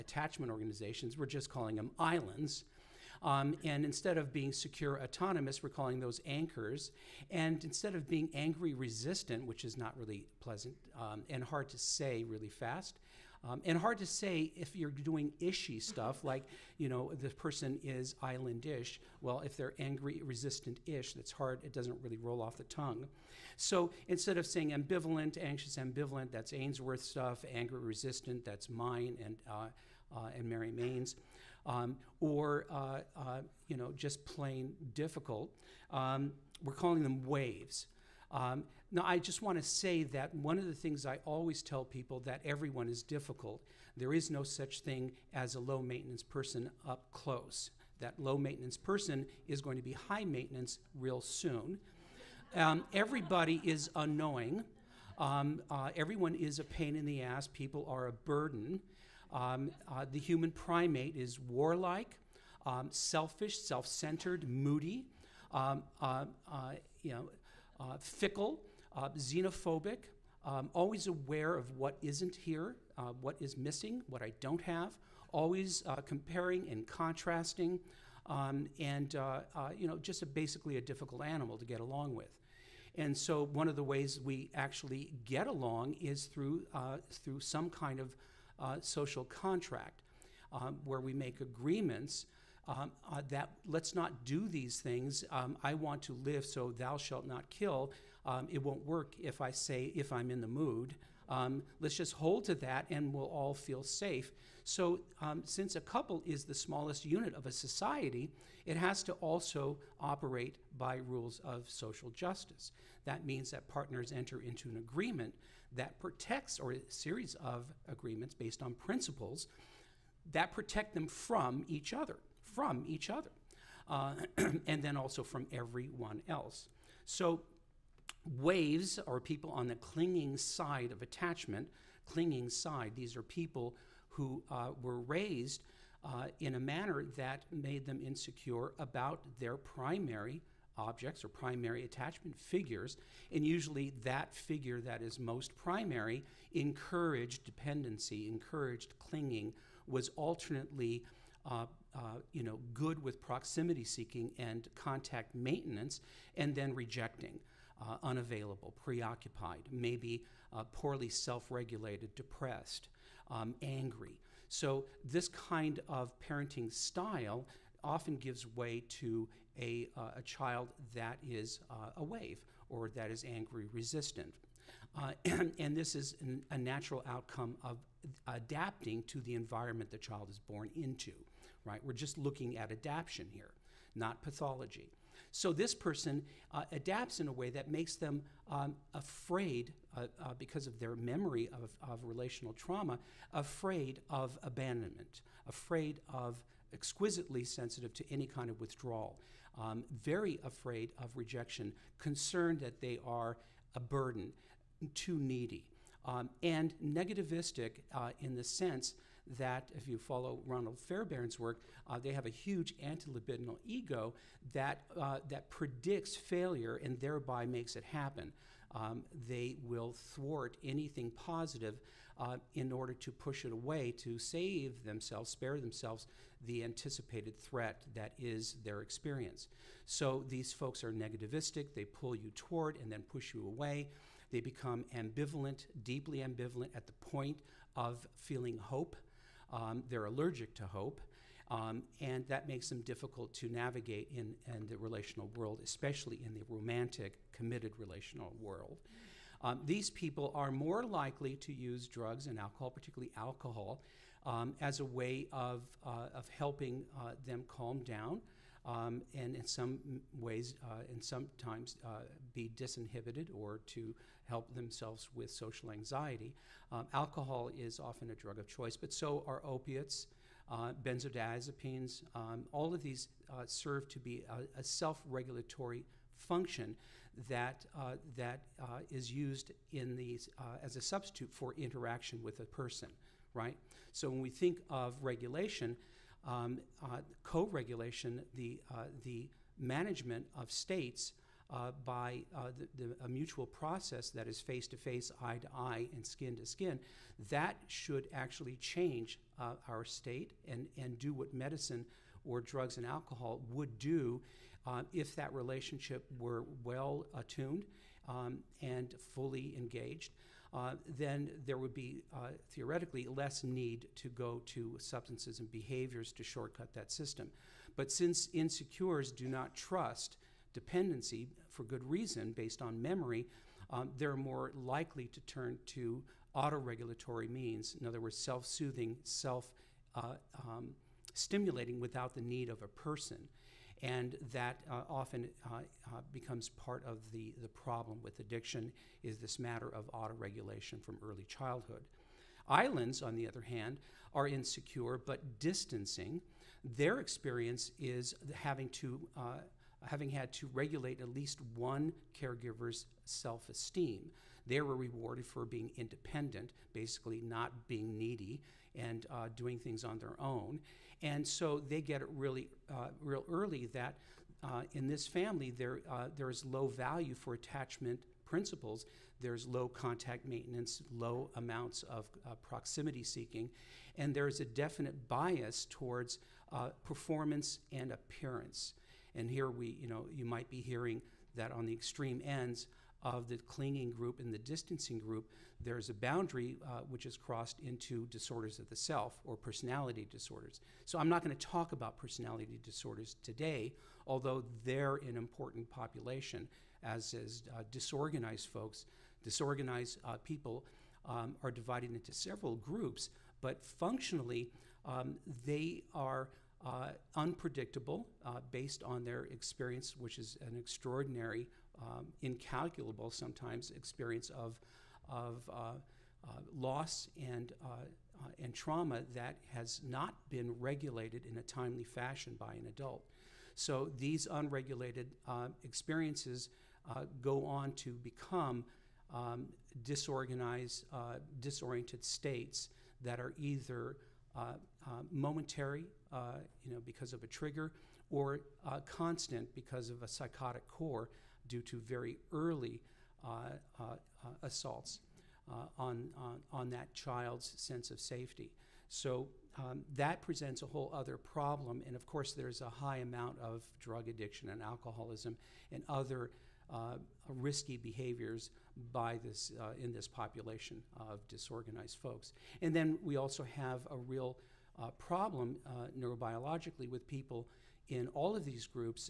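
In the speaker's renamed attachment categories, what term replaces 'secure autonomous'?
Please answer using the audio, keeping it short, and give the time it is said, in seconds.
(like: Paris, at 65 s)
Anchors, at 6 s.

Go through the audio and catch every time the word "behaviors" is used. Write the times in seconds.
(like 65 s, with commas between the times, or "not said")
315 s, 457 s.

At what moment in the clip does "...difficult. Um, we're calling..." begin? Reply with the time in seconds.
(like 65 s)
34 s.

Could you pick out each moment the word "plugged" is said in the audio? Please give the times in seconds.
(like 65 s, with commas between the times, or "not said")
not said.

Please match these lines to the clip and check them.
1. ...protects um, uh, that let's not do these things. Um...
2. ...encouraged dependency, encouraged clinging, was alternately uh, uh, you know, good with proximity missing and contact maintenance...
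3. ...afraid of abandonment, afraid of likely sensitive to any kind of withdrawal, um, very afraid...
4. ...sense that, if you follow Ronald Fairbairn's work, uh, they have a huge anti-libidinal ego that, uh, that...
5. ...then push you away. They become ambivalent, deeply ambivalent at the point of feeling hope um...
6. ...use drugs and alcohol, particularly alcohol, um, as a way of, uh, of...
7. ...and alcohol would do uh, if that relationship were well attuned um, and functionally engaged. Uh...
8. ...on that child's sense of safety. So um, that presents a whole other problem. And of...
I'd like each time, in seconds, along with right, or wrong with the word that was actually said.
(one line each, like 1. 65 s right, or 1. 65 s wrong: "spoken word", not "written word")
1. 91 s wrong: "agreements", not "protects"
2. 146 s wrong: "seeking", not "missing"
3. 193 s wrong: "exquisitely", not "likely"
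4. 208 s right
5. 232 s right
6. 251 s right
7. 302 s wrong: "fully", not "functionally"
8. 446 s right.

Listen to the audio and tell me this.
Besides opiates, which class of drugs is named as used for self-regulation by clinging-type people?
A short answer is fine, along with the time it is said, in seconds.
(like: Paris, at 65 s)
Benzodiazepines, at 270 s.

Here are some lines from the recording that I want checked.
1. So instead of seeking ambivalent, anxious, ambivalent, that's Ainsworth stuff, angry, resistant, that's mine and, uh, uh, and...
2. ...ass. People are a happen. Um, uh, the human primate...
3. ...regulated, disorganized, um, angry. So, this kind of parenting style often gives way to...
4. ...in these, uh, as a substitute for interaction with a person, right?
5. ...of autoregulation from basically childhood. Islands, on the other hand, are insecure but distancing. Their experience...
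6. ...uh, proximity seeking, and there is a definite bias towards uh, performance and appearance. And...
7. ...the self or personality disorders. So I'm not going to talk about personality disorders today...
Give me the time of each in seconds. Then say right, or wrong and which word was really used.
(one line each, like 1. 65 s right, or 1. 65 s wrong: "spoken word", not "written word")
1. 23 s wrong: "saying", not "seeking"
2. 57 s wrong: "burden", not "happen"
3. 161 s wrong: "depressed", not "disorganized"
4. 279 s right
5. 339 s wrong: "early", not "basically"
6. 372 s right
7. 388 s right.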